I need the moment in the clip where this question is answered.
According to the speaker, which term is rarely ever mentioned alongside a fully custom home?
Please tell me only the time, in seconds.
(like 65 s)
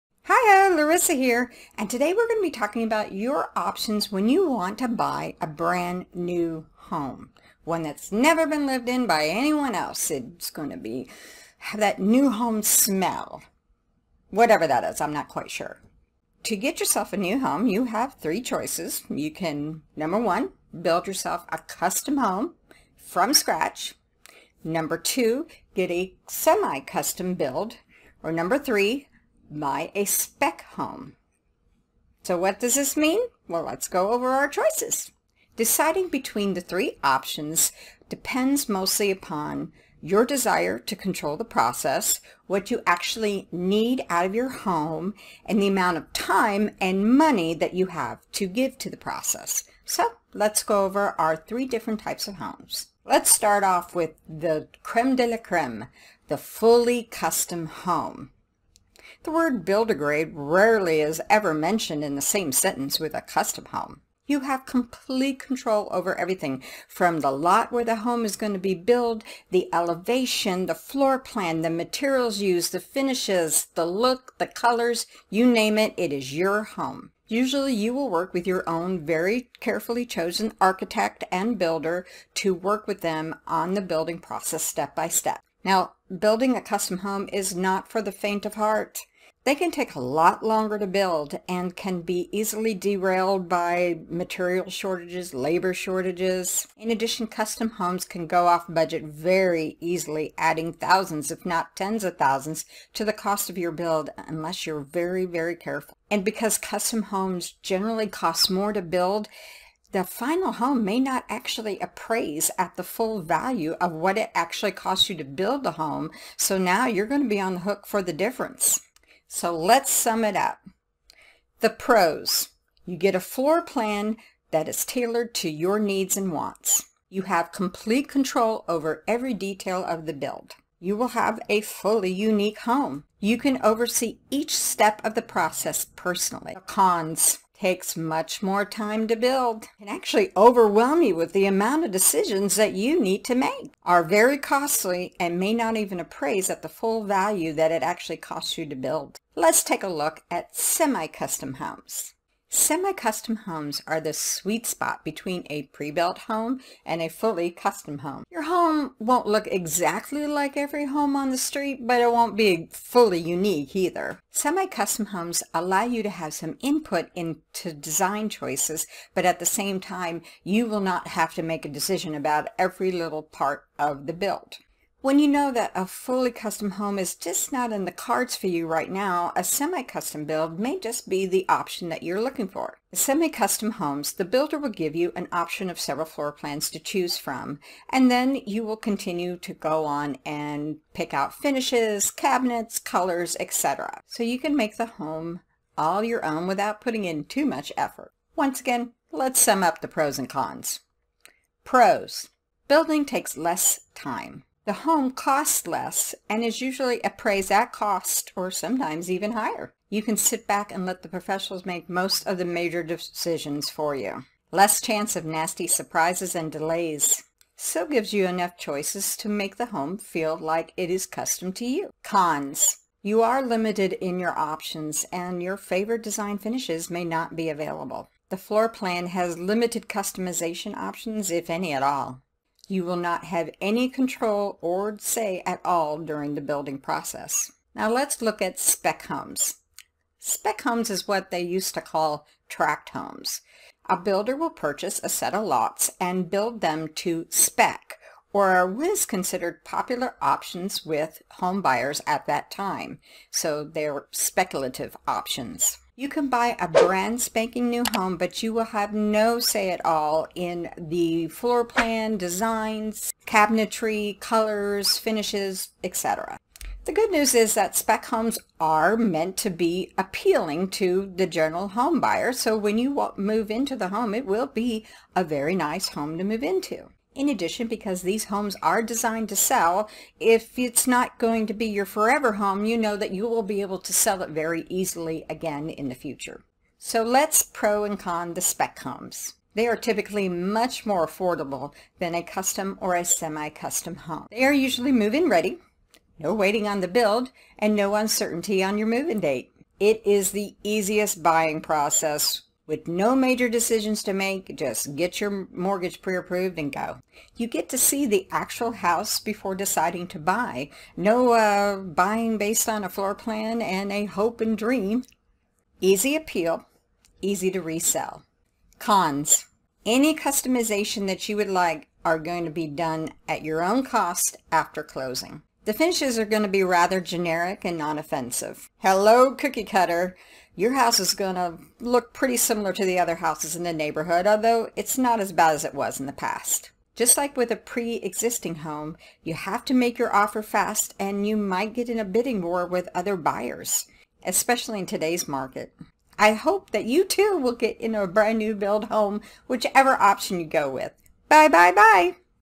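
59 s.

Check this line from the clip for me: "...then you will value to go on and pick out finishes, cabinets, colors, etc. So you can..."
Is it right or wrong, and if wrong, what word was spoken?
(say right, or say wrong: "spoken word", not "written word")
wrong: "continue", not "value".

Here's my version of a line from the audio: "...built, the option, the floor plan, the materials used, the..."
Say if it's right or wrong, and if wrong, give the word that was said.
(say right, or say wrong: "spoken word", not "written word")
wrong: "elevation", not "option".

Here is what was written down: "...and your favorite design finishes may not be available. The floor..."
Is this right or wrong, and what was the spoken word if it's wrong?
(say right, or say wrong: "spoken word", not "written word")
right.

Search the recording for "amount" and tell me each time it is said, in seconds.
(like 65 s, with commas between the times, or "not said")
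45 s, 141 s.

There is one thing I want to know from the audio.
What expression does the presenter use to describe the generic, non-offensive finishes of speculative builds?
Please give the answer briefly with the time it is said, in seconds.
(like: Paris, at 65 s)
cookie cutter, at 329 s.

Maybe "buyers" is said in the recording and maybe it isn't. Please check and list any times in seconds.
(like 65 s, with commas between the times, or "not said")
251 s, 272 s, 343 s.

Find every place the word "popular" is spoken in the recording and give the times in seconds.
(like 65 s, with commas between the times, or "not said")
249 s.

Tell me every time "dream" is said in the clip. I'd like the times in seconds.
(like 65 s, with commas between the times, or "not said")
314 s.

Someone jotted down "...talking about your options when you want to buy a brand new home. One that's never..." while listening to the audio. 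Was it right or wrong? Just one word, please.
right.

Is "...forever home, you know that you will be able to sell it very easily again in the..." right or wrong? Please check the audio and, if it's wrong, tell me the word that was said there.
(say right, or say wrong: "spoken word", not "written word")
right.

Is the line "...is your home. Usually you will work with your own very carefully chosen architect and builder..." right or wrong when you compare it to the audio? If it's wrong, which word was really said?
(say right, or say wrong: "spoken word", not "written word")
right.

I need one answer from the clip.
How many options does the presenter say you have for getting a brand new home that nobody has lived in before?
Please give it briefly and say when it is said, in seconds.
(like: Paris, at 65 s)
3, at 18 s.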